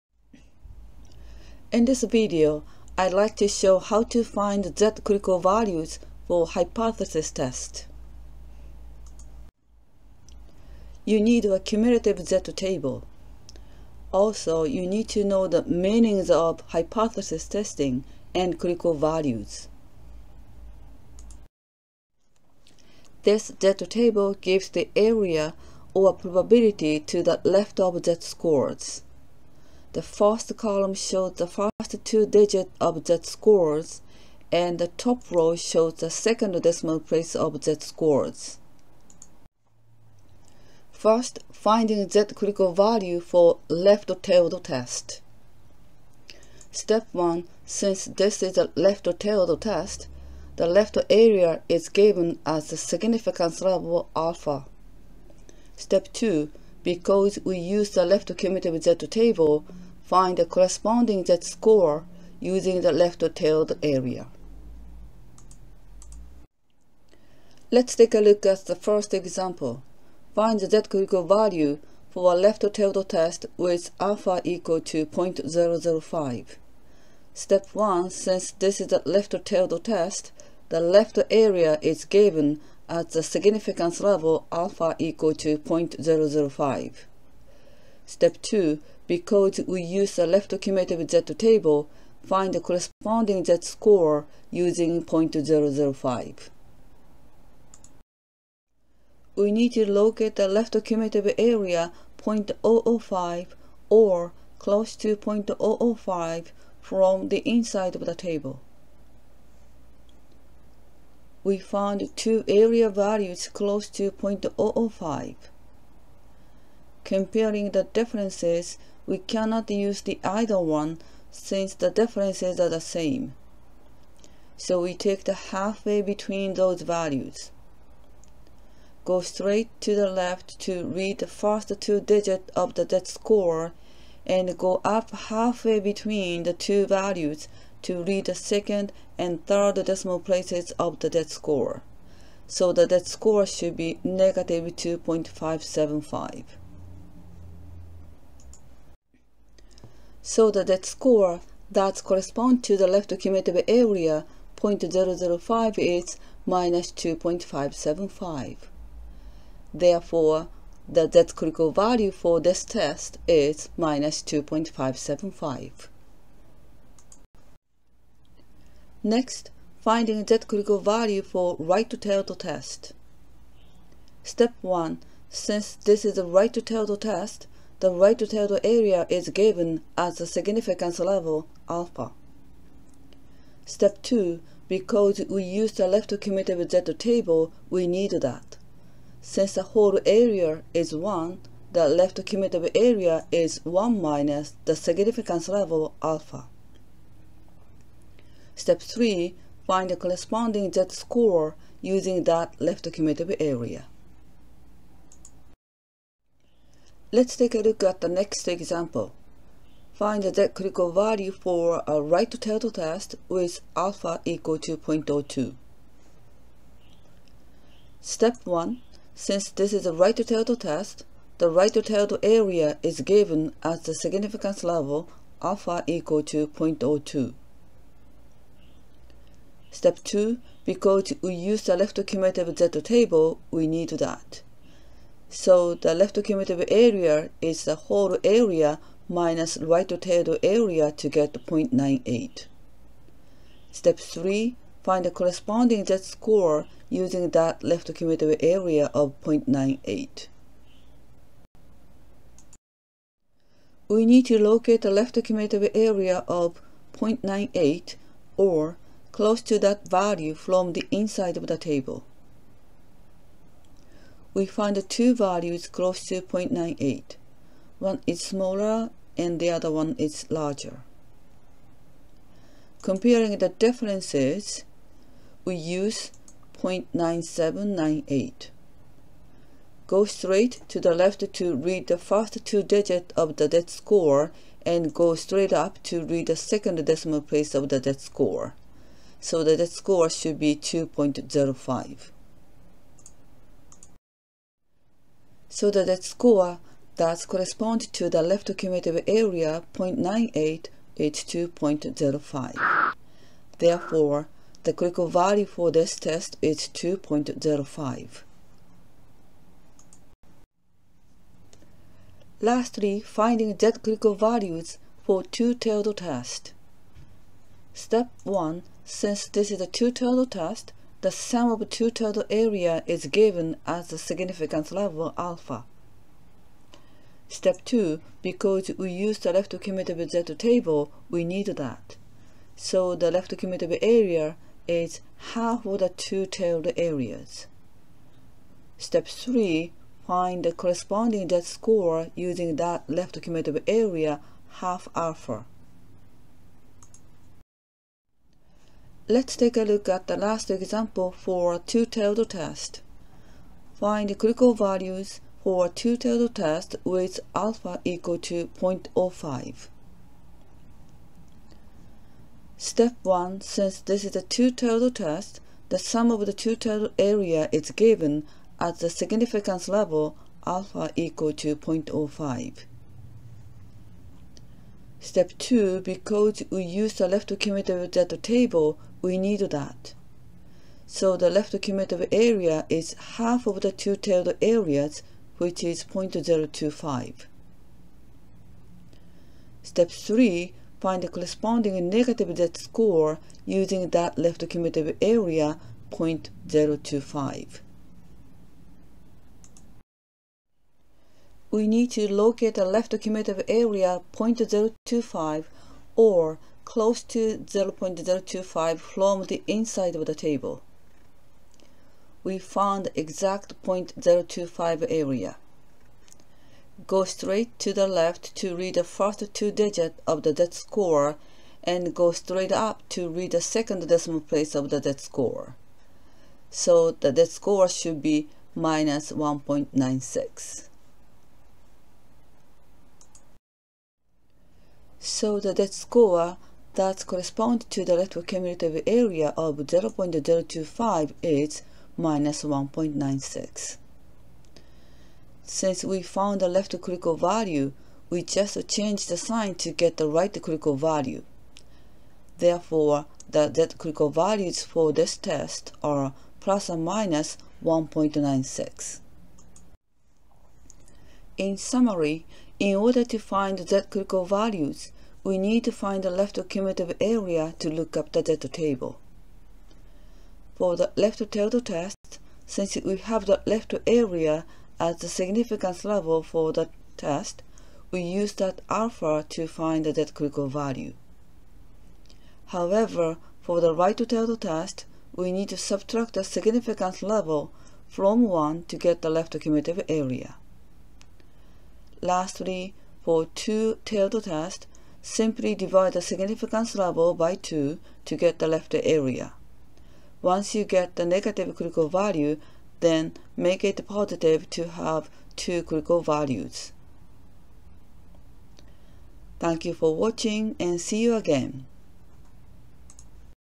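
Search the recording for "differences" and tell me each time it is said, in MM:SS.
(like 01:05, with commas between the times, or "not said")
01:57, 02:01, 04:33.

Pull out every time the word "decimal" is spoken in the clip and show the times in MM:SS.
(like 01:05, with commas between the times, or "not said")
00:36, 02:19, 04:46, 07:03.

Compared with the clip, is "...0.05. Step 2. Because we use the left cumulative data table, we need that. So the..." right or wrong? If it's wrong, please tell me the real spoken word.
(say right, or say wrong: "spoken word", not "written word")
right.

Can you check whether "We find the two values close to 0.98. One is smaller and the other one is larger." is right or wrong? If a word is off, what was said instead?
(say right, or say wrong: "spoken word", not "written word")
right.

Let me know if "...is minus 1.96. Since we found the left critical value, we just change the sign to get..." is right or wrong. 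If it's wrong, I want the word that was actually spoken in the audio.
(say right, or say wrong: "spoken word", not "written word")
right.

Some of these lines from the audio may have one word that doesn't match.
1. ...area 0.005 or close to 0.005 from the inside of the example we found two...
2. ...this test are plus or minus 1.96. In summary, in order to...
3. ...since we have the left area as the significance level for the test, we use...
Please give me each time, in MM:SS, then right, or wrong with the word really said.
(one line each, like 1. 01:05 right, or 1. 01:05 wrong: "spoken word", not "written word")
1. 01:41 wrong: "table", not "example"
2. 07:34 right
3. 07:52 right.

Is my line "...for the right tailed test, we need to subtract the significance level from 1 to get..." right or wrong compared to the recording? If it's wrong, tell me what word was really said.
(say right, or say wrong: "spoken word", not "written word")
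right.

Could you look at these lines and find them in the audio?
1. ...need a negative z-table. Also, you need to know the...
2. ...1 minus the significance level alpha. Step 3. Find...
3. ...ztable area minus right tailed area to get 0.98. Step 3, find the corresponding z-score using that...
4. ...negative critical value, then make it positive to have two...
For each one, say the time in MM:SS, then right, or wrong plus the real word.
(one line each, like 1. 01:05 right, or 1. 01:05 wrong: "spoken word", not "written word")
1. 00:11 wrong: "cumulative", not "negative"
2. 03:13 right
3. 03:57 wrong: "whole", not "ztable"
4. 08:21 right.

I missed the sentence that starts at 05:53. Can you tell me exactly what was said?
Find critical values for a two-tailed test with alpha equal to 0.05.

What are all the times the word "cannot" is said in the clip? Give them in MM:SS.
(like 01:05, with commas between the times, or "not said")
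01:59.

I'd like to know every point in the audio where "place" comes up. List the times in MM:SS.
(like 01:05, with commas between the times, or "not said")
00:37, 02:20, 04:47, 07:04.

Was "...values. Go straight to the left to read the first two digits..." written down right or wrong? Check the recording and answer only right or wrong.
right.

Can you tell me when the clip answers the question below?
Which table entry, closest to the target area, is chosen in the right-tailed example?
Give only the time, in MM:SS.
04:36.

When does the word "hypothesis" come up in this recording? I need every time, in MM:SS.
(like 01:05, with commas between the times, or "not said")
00:06, 00:16.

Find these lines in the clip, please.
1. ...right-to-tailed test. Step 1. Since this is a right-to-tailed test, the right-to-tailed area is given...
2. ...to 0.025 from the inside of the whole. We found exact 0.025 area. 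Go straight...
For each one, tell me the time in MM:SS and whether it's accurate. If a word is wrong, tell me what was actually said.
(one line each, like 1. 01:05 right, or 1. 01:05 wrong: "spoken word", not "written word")
1. 02:51 right
2. 06:47 wrong: "table", not "whole".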